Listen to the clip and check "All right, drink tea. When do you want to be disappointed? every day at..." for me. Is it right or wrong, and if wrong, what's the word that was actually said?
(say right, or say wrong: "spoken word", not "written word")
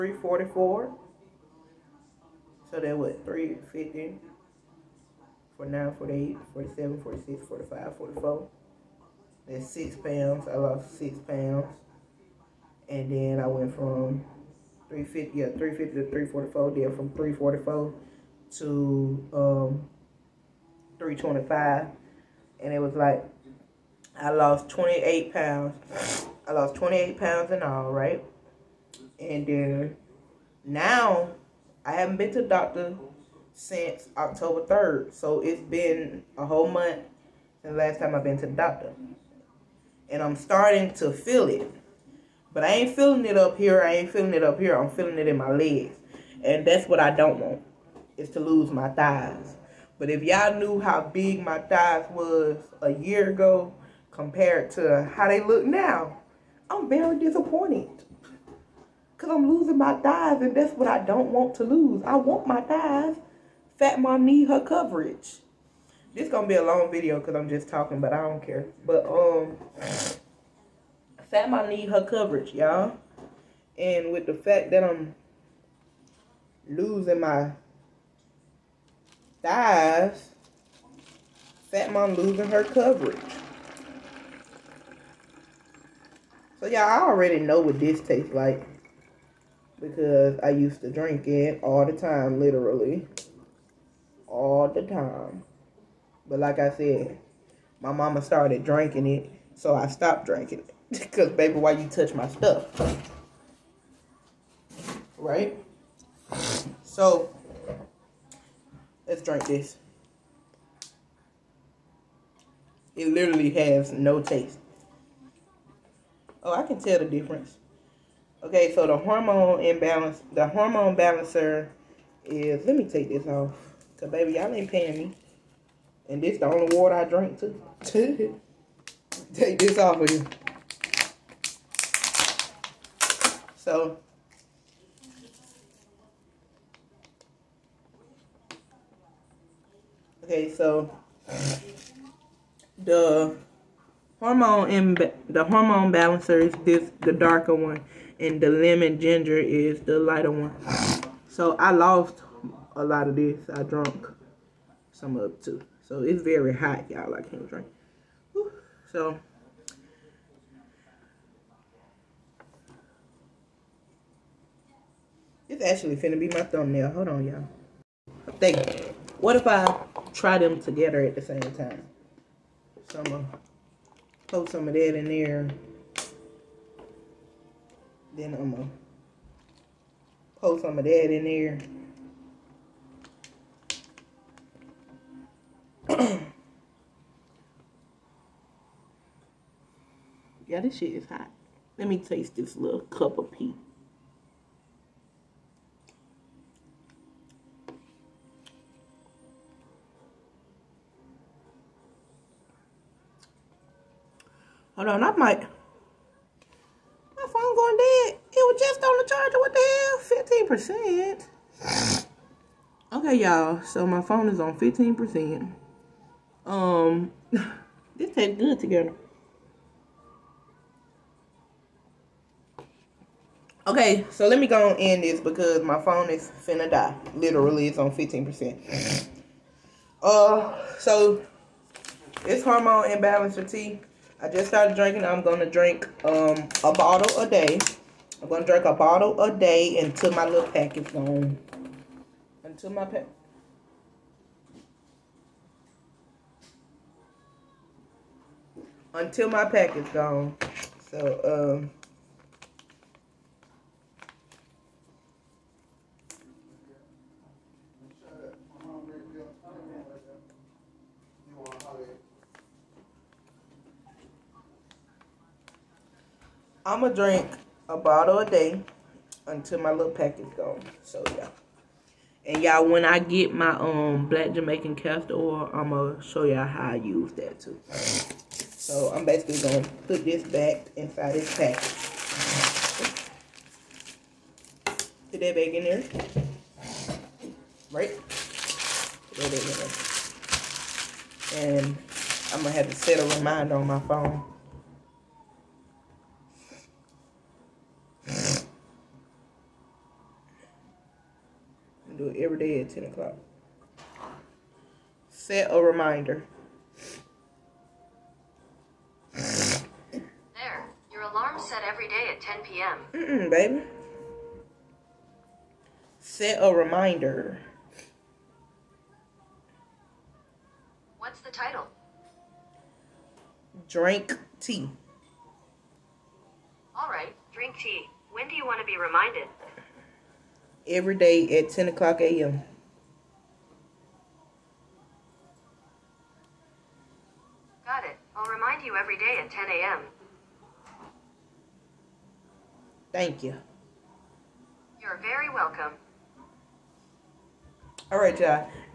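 wrong: "reminded", not "disappointed".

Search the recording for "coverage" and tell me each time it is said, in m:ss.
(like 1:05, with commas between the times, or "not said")
1:04, 1:12, 1:22.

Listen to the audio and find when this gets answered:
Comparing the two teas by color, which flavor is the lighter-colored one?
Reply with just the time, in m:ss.
2:28.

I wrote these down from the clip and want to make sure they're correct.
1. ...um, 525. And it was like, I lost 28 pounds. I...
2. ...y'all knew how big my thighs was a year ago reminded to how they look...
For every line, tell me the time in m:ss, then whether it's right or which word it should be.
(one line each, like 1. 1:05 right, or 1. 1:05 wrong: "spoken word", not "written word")
1. 0:19 wrong: "325", not "525"
2. 0:50 wrong: "compared", not "reminded".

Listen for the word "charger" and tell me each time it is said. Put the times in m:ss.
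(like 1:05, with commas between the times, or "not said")
3:29.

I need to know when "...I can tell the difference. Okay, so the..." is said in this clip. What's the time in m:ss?
1:56.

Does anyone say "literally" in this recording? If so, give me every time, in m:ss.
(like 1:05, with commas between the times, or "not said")
1:32, 1:53, 3:47.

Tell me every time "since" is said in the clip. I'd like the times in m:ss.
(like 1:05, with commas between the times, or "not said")
0:33, 0:37.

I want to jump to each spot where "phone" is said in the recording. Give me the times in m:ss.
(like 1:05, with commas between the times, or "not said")
3:27, 3:34, 3:45, 4:53.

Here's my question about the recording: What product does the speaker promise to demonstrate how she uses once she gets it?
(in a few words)
Black Jamaican castor oil.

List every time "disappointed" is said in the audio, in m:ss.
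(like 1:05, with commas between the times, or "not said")
0:57.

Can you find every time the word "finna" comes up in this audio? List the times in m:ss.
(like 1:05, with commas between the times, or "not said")
2:45, 3:46.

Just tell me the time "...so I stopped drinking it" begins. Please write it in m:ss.
1:39.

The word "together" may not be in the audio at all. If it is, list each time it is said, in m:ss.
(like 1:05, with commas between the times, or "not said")
2:50, 3:38.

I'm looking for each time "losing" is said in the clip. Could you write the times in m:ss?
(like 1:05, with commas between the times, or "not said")
0:59, 1:16, 1:22.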